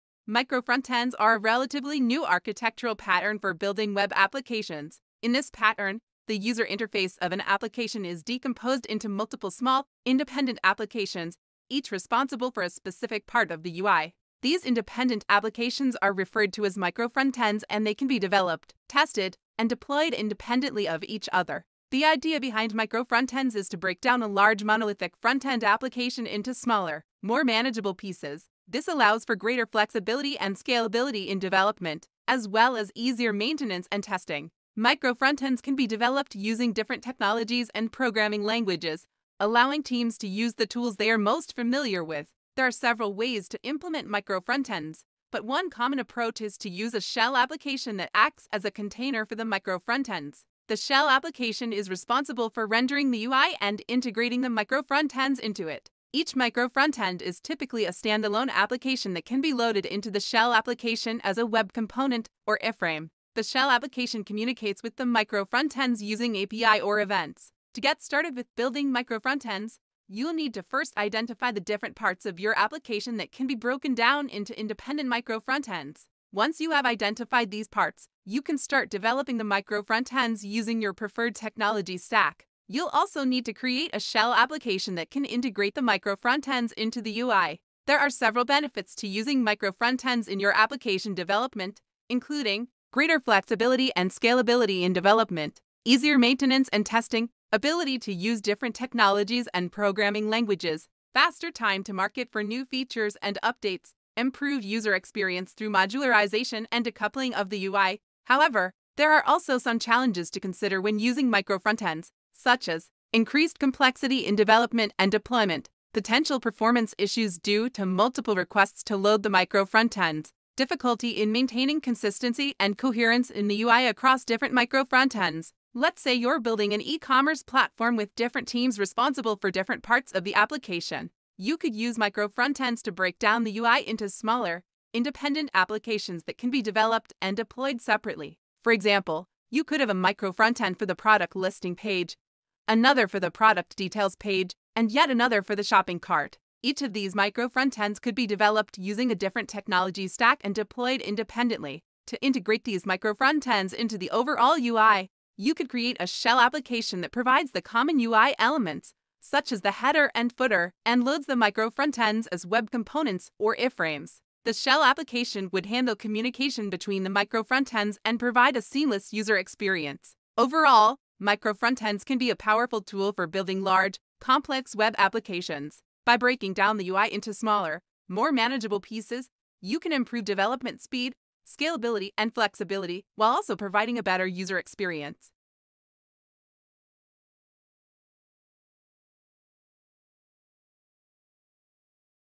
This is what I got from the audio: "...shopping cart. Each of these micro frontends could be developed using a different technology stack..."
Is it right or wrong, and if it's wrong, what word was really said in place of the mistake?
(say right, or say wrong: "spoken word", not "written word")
right.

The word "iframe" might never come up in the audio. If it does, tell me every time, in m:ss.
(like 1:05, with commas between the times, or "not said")
1:02, 2:43.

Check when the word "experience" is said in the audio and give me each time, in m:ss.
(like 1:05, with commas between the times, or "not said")
1:44, 2:49, 3:04.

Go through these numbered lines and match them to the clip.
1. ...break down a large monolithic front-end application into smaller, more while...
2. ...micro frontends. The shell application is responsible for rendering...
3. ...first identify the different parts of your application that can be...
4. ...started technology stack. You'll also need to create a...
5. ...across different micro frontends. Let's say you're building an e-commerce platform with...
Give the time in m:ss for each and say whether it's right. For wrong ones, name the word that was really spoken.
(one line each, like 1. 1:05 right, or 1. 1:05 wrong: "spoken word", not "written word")
1. 0:23 wrong: "manageable", not "while"
2. 0:49 right
3. 1:10 right
4. 1:20 wrong: "preferred", not "started"
5. 2:03 right.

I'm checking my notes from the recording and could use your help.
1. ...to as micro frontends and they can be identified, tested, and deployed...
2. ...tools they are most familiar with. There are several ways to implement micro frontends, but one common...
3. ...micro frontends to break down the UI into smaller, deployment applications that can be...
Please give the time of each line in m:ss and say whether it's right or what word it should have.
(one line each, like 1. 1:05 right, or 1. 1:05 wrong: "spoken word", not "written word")
1. 0:16 wrong: "developed", not "identified"
2. 0:40 right
3. 2:11 wrong: "independent", not "deployment".